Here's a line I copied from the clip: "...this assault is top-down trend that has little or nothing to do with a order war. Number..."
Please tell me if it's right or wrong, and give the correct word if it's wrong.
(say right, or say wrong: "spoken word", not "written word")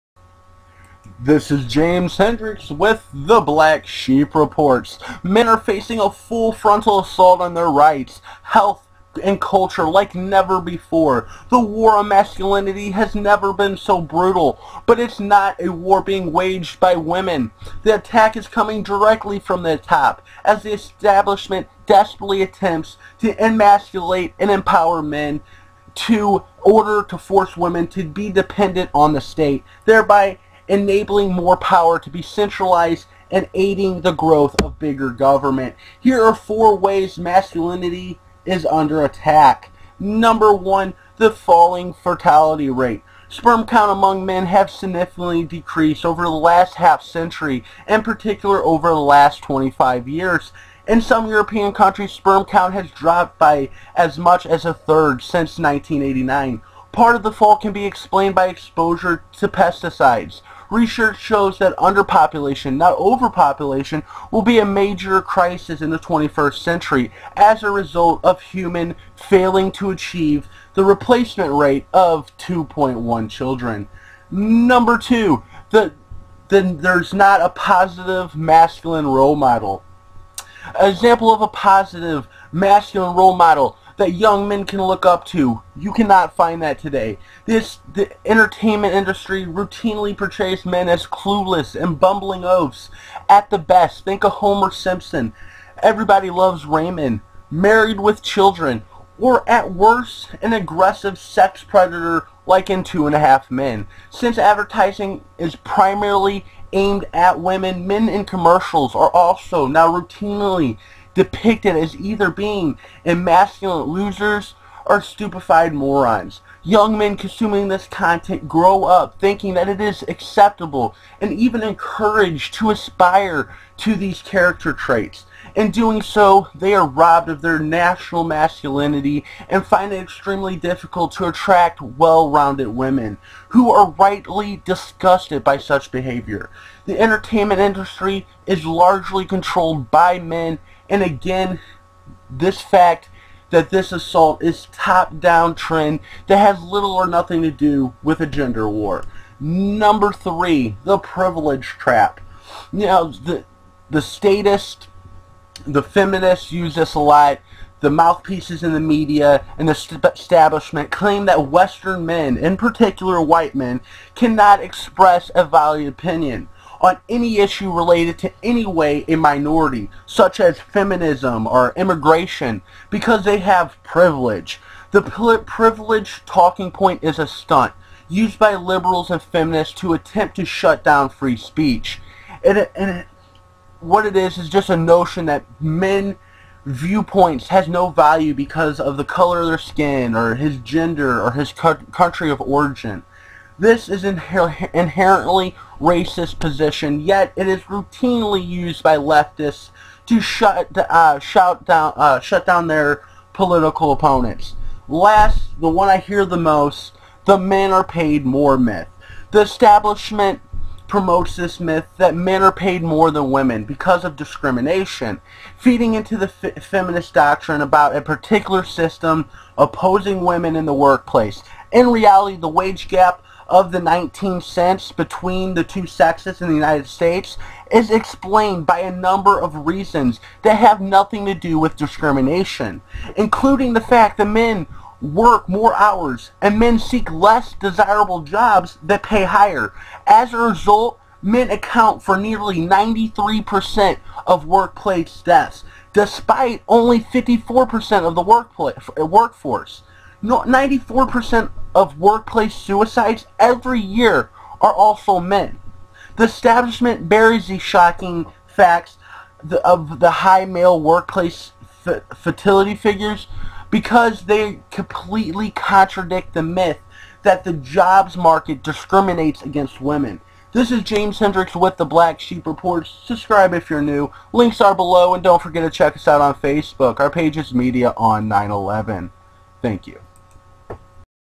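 wrong: "gender", not "order".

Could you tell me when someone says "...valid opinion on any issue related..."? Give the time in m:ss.
2:45.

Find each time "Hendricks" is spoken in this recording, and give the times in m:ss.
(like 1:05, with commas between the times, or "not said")
0:02, 4:31.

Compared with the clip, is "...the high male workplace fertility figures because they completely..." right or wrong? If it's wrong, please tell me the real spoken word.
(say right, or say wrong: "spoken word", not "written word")
right.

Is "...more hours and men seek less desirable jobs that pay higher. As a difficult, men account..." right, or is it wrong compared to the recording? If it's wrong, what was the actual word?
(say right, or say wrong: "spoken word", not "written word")
wrong: "result", not "difficult".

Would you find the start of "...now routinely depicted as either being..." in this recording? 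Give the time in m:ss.
1:49.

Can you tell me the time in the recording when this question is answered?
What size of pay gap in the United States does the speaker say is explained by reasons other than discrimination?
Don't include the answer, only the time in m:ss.
3:43.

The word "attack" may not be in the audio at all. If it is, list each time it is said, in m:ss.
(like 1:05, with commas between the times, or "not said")
0:17, 0:39.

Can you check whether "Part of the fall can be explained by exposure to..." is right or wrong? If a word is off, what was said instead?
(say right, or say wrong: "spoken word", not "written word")
right.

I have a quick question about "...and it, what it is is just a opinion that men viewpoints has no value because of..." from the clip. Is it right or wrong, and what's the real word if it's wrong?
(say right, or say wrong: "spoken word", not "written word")
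wrong: "notion", not "opinion".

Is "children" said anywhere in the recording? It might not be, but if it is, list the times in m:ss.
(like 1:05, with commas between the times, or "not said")
1:13, 1:38.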